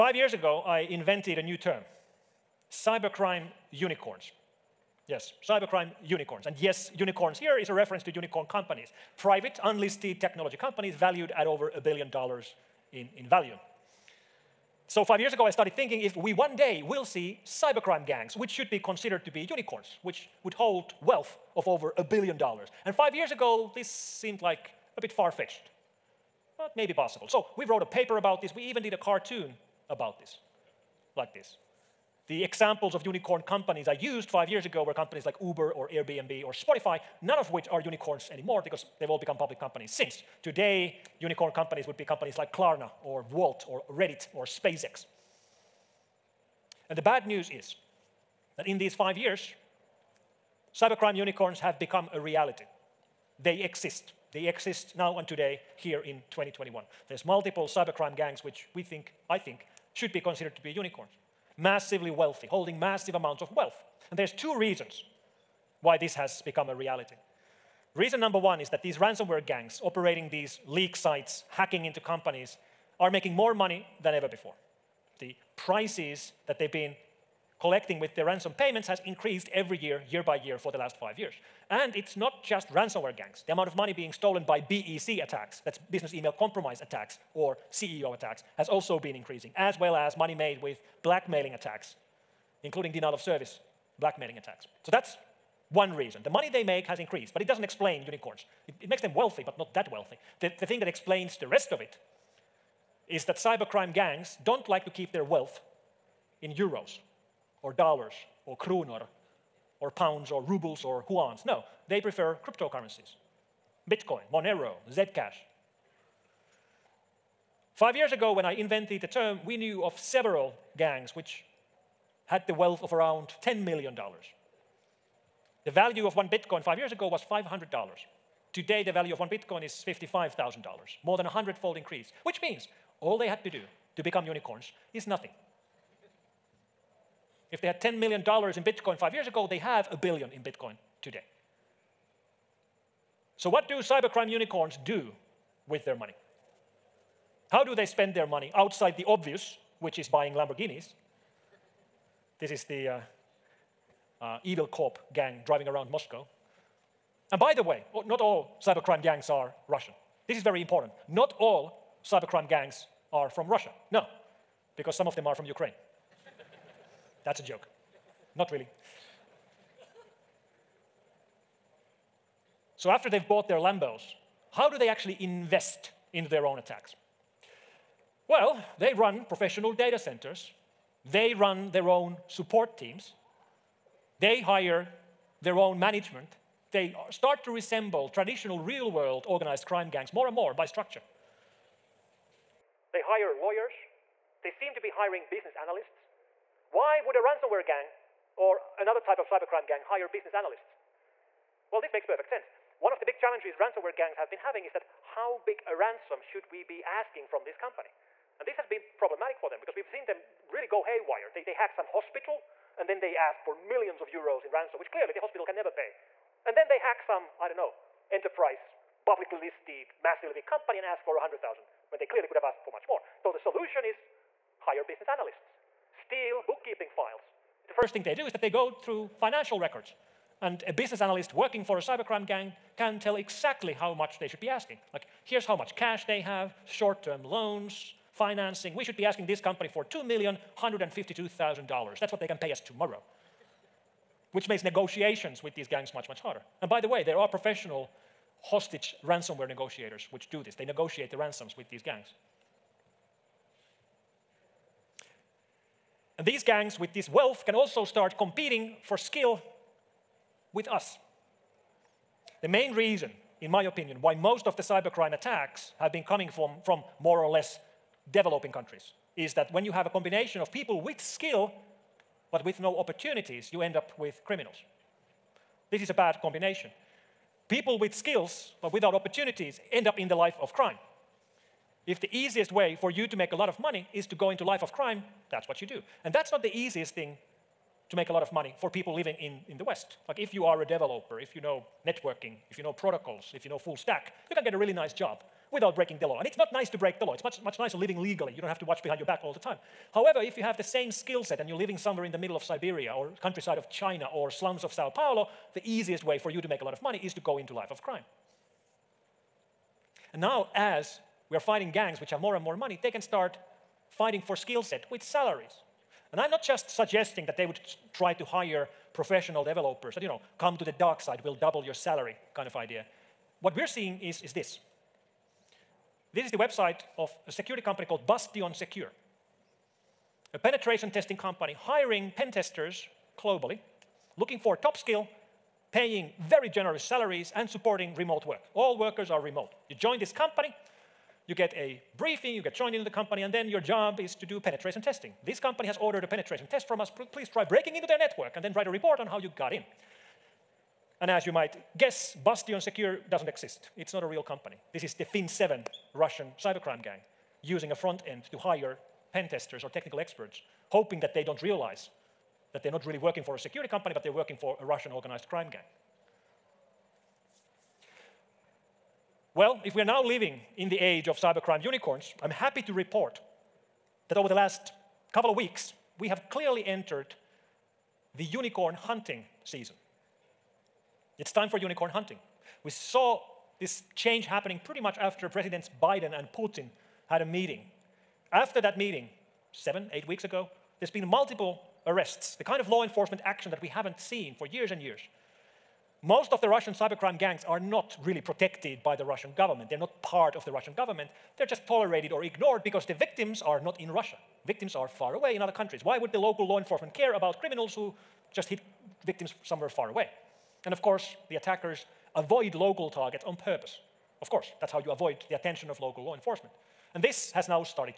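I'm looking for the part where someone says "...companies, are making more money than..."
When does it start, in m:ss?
1:11.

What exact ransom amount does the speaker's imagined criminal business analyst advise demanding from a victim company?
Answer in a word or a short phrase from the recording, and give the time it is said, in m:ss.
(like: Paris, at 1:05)
2 million $152,000, at 3:59.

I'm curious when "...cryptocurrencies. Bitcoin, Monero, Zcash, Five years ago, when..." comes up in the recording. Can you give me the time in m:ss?
1:52.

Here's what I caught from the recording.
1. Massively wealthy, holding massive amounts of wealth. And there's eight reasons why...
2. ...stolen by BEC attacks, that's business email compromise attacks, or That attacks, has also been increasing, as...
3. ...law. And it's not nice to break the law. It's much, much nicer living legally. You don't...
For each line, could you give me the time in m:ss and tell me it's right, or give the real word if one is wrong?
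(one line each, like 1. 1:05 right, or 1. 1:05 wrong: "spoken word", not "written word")
1. 1:01 wrong: "two", not "eight"
2. 1:24 wrong: "CEO", not "That"
3. 4:56 right.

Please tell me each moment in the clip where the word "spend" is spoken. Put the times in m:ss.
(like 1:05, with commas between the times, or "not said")
2:27.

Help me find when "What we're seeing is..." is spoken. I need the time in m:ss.
5:23.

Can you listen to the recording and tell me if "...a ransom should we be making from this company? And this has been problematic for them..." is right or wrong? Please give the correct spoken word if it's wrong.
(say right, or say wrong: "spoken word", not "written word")
wrong: "asking", not "making".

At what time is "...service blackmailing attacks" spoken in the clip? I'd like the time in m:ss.
1:33.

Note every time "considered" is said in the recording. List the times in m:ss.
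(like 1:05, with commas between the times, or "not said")
0:18, 1:00.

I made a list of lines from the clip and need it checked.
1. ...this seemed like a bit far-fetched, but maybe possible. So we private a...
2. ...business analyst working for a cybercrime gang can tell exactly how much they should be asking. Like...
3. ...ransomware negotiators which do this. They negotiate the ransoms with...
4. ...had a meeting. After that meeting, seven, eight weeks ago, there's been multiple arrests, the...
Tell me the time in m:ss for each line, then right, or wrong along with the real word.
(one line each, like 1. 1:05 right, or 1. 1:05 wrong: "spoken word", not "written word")
1. 0:23 wrong: "wrote", not "private"
2. 3:50 right
3. 4:09 right
4. 6:27 right.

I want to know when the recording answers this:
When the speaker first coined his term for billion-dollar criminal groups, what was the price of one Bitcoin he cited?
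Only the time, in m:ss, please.
2:07.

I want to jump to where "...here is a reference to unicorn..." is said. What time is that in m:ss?
0:07.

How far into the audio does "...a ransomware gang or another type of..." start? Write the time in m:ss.
3:17.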